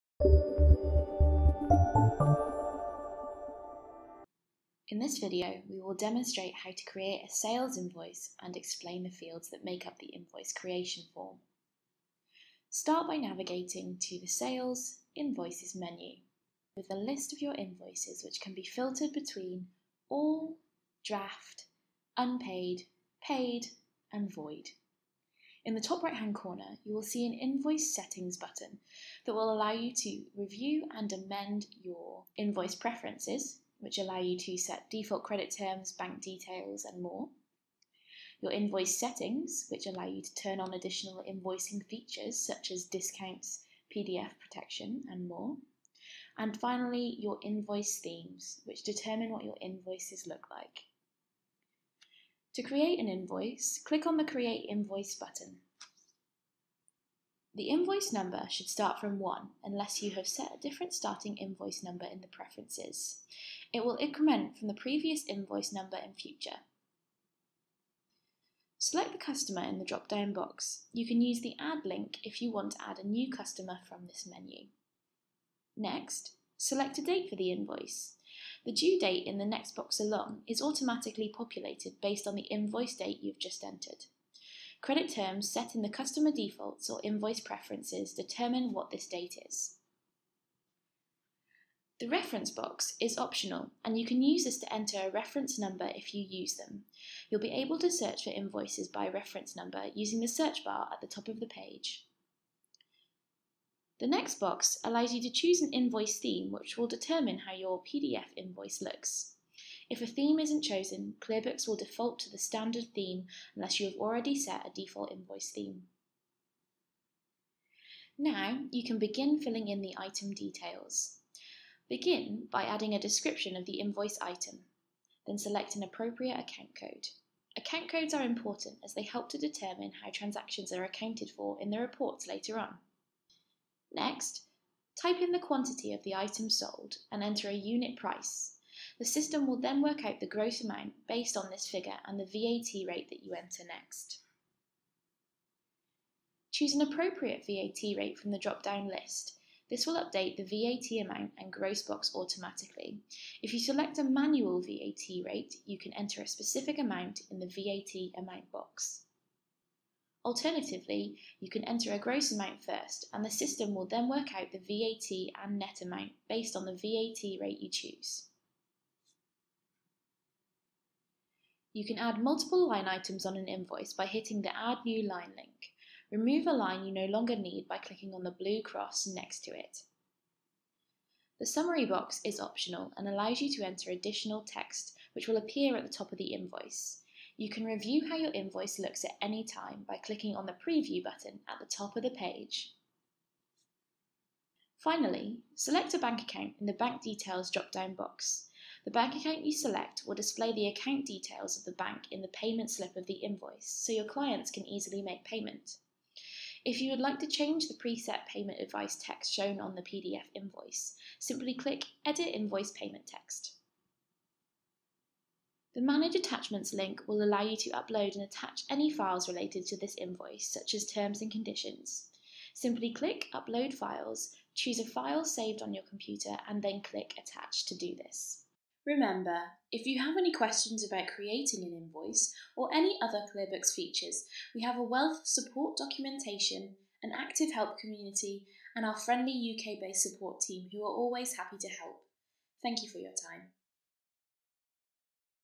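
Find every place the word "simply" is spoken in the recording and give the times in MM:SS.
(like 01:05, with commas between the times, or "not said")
03:31, 03:42.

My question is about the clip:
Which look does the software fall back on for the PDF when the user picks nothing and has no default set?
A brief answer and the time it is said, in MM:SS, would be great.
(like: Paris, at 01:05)
standard theme, at 01:52.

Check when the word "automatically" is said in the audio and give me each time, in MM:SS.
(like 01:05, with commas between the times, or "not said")
01:20, 02:32.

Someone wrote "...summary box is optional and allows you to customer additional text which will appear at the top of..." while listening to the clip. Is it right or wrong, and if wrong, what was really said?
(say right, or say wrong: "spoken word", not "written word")
wrong: "enter", not "customer".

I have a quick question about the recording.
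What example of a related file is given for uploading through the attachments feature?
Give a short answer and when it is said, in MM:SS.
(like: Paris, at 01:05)
terms and conditions, at 03:40.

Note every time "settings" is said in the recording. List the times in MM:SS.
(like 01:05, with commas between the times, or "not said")
00:27, 00:38.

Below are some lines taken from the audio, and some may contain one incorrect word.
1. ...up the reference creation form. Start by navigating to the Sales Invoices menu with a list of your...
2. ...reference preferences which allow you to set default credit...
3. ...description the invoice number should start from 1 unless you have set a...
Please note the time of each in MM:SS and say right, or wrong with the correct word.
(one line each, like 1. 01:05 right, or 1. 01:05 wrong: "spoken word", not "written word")
1. 00:09 wrong: "invoice", not "reference"
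2. 00:32 wrong: "invoice", not "reference"
3. 00:55 wrong: "button", not "description".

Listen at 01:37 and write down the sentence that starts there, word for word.
You'll be able to search for invoices by reference number using the search bar at the top of the page.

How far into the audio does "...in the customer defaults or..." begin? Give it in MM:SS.
01:25.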